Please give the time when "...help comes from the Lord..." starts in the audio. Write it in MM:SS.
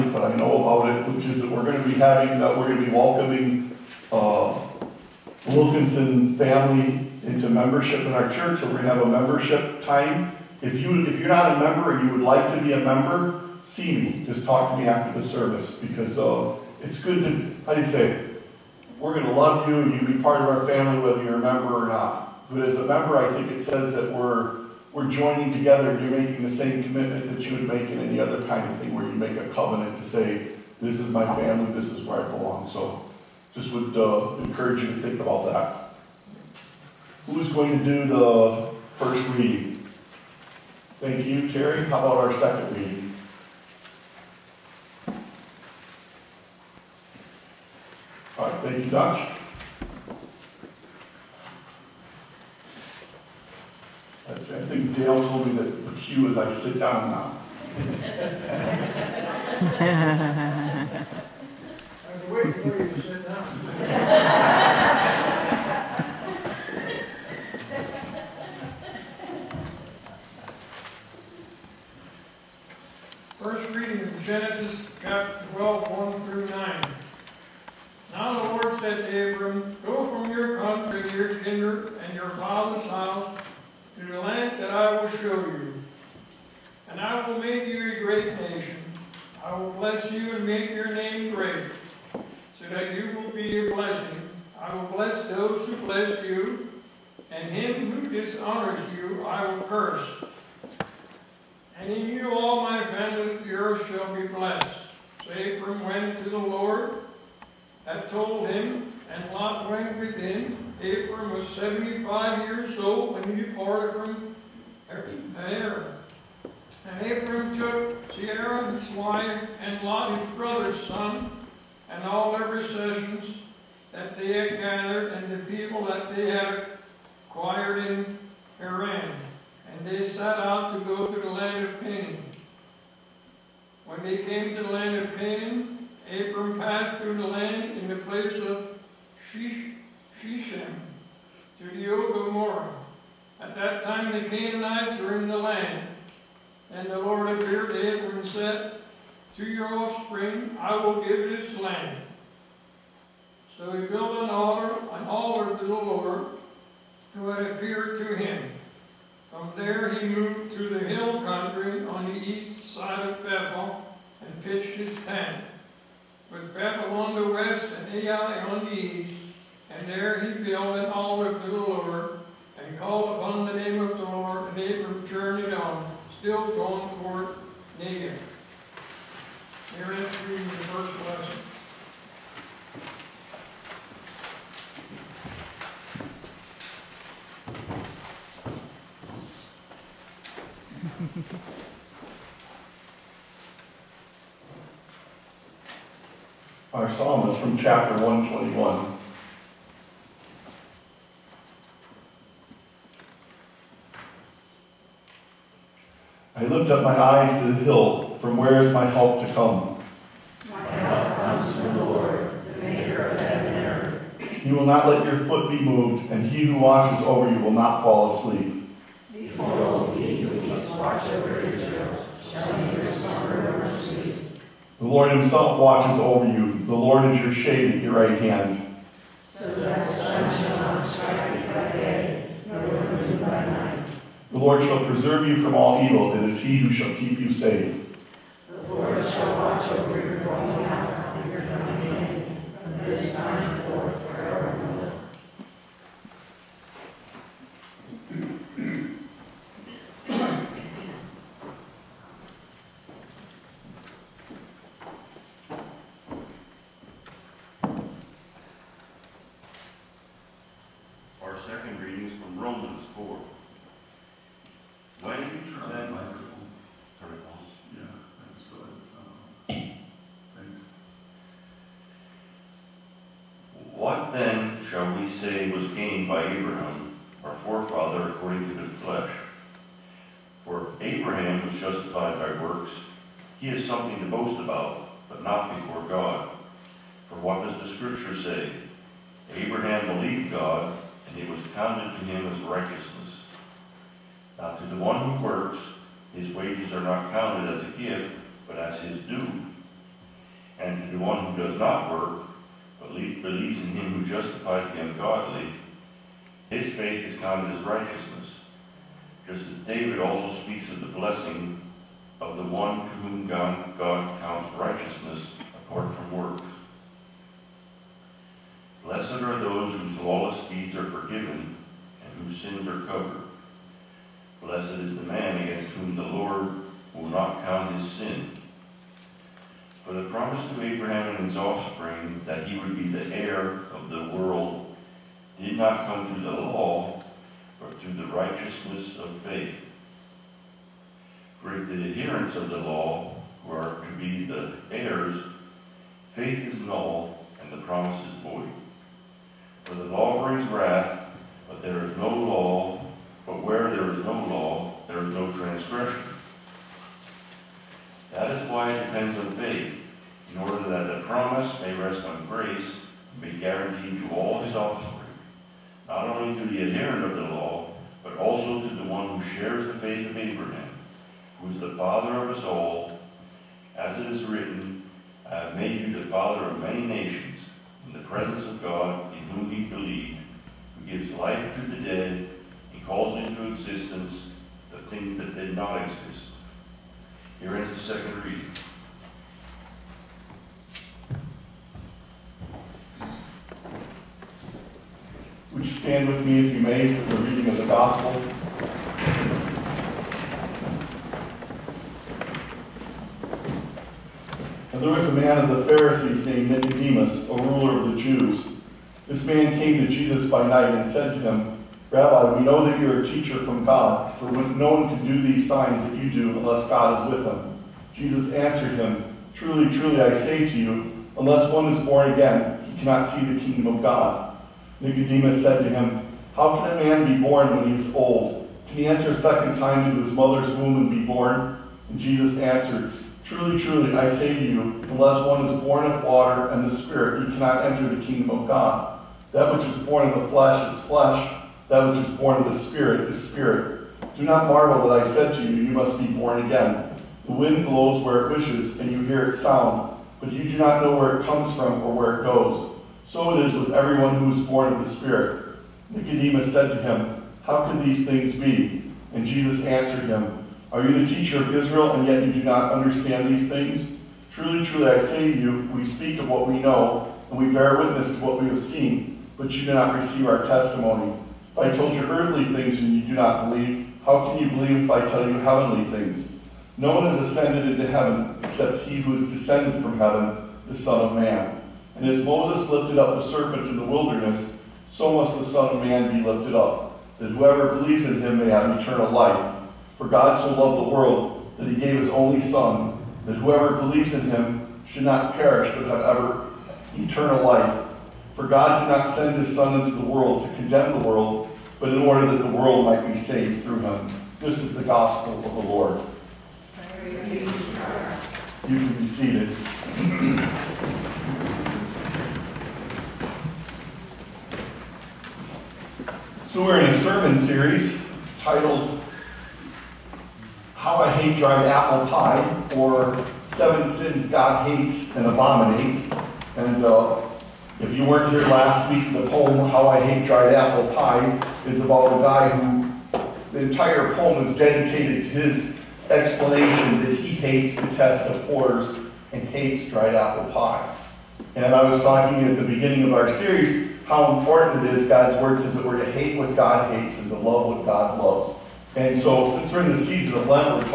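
03:30.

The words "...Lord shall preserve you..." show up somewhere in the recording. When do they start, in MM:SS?
03:54.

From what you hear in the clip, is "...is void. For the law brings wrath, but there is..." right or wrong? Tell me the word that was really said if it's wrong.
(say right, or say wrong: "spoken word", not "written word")
right.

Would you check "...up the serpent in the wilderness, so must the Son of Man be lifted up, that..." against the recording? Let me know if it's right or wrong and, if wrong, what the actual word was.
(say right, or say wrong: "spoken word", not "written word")
right.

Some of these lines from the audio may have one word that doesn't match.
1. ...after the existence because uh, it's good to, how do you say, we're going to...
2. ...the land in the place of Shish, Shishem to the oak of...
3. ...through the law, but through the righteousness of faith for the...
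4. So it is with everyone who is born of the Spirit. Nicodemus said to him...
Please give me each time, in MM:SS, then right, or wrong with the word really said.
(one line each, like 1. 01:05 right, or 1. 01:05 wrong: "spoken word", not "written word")
1. 00:14 wrong: "service", not "existence"
2. 02:17 right
3. 05:36 right
4. 07:33 right.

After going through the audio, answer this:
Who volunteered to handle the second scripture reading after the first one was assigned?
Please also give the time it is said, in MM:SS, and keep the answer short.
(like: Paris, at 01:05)
Dutch, at 00:48.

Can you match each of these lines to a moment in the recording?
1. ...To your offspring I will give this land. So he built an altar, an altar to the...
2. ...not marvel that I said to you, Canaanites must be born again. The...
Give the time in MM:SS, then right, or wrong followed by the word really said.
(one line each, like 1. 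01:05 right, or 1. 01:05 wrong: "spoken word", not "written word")
1. 02:29 right
2. 07:24 wrong: "You", not "Canaanites".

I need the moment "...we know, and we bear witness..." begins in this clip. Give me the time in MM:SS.
07:46.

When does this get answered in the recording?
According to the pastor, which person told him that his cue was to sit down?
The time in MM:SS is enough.
00:54.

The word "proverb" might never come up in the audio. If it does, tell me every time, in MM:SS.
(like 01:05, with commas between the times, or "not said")
not said.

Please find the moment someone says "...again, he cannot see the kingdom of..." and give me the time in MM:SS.
07:02.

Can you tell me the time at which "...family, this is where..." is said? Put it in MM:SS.
00:31.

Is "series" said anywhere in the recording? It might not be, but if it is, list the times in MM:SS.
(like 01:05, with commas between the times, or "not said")
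08:37, 09:03.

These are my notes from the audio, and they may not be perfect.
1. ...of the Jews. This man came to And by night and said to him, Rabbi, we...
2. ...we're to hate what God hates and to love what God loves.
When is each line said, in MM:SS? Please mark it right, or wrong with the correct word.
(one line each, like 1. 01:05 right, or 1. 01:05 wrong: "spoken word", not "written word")
1. 06:47 wrong: "Jesus", not "And"
2. 09:05 right.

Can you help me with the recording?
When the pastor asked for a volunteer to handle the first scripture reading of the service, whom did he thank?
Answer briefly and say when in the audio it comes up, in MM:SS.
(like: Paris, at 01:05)
Terry, at 00:41.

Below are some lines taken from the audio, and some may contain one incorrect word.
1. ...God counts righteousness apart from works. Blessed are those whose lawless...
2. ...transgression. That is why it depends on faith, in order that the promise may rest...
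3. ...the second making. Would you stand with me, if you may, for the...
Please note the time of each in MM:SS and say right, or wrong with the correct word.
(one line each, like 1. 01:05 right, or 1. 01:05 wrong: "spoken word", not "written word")
1. 05:13 right
2. 05:55 right
3. 06:27 wrong: "reading", not "making".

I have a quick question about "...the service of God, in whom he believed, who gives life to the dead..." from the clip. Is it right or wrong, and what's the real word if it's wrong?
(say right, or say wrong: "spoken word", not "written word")
wrong: "presence", not "service".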